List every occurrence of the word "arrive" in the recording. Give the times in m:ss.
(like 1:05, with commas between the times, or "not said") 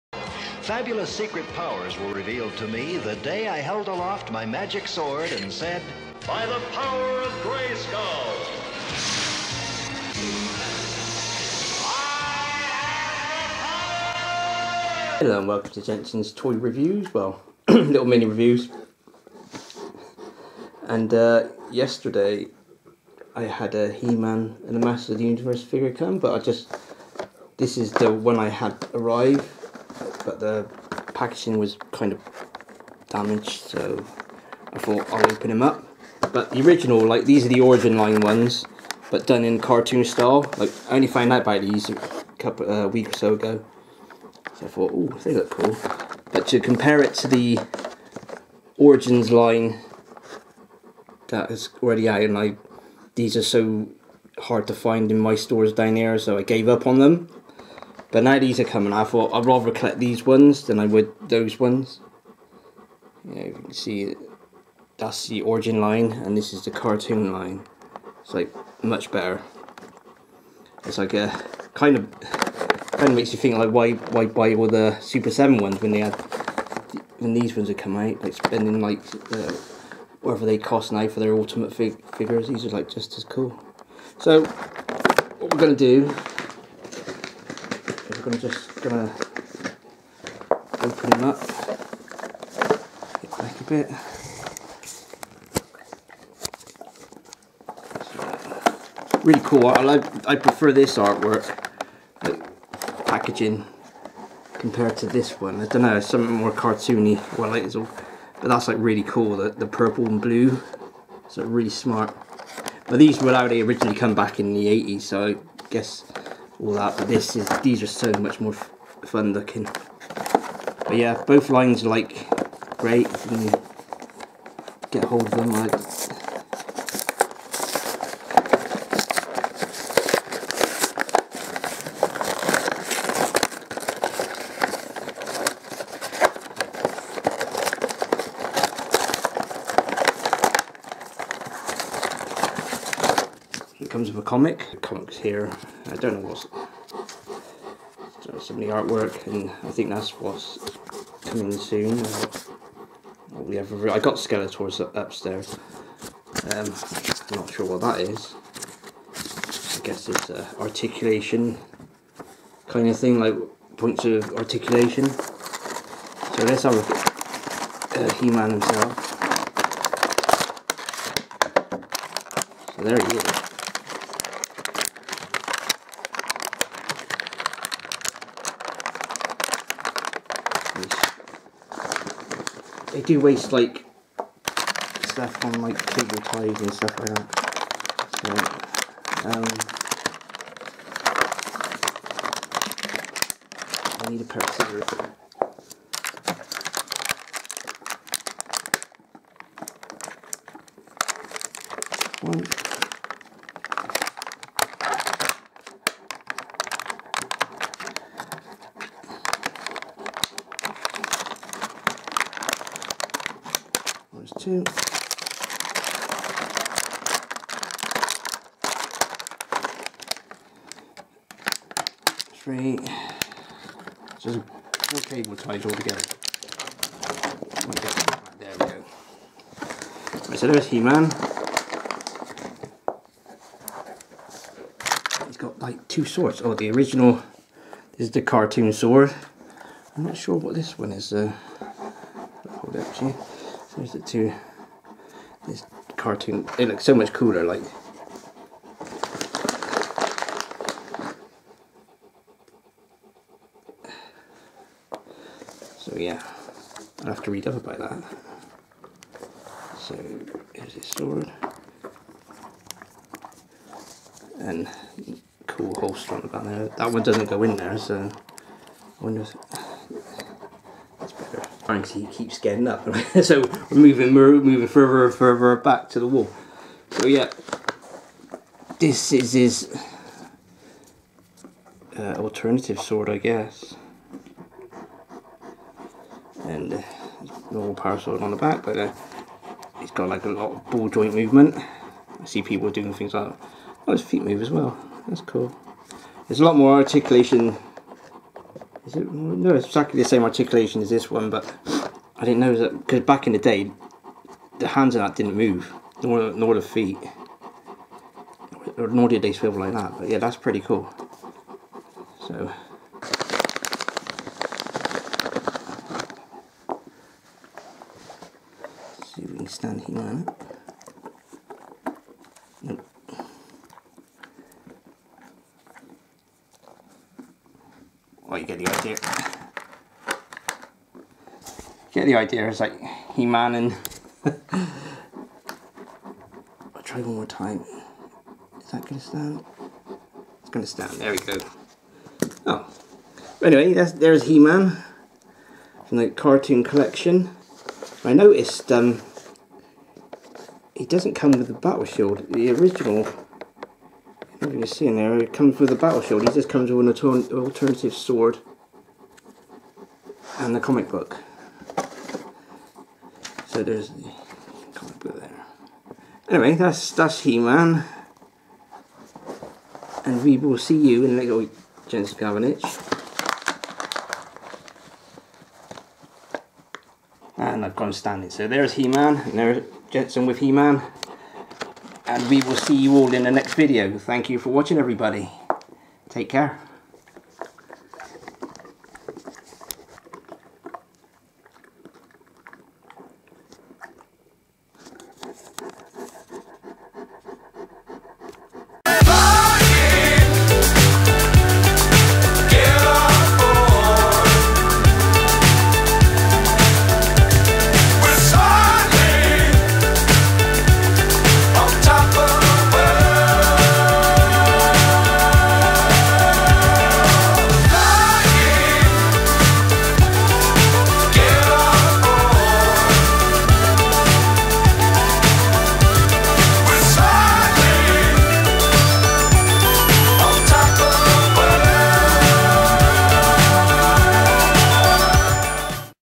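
0:28.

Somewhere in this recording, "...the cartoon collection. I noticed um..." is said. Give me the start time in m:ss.
5:45.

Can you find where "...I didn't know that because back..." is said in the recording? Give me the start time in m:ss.
5:02.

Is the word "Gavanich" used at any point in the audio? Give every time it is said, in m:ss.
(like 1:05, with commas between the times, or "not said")
6:12.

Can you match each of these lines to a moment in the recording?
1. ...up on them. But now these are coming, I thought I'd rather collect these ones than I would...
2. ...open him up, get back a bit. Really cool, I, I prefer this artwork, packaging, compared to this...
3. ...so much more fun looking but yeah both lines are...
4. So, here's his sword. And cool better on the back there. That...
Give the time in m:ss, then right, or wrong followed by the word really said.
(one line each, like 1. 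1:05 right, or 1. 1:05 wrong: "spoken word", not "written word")
1. 0:56 right
2. 1:30 right
3. 1:57 right
4. 4:19 wrong: "holster", not "better".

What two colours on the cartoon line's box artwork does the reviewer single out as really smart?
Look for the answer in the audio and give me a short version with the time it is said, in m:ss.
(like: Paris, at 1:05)
Purple and blue, at 1:49.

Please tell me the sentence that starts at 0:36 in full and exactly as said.
But the original, like these are the origin line ones, but done in cartoon style.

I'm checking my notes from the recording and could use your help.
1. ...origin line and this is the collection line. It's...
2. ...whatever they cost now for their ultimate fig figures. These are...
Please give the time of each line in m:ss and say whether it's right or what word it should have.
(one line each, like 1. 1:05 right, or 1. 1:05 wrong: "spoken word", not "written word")
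1. 1:05 wrong: "cartoon", not "collection"
2. 1:20 right.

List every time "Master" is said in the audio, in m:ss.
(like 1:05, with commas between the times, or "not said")
0:24.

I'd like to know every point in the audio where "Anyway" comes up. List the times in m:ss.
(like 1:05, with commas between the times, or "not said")
5:43, 6:06.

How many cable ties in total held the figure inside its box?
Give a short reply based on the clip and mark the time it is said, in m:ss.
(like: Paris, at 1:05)
4, at 3:44.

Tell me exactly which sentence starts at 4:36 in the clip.
So yeah, this is his uh, alternative sword, I guess.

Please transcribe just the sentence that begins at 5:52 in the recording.
The original you you see in there, it comes with a battle shield.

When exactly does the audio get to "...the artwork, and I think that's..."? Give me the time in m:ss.
2:28.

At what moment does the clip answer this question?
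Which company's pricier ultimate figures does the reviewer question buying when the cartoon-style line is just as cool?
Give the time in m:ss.
1:14.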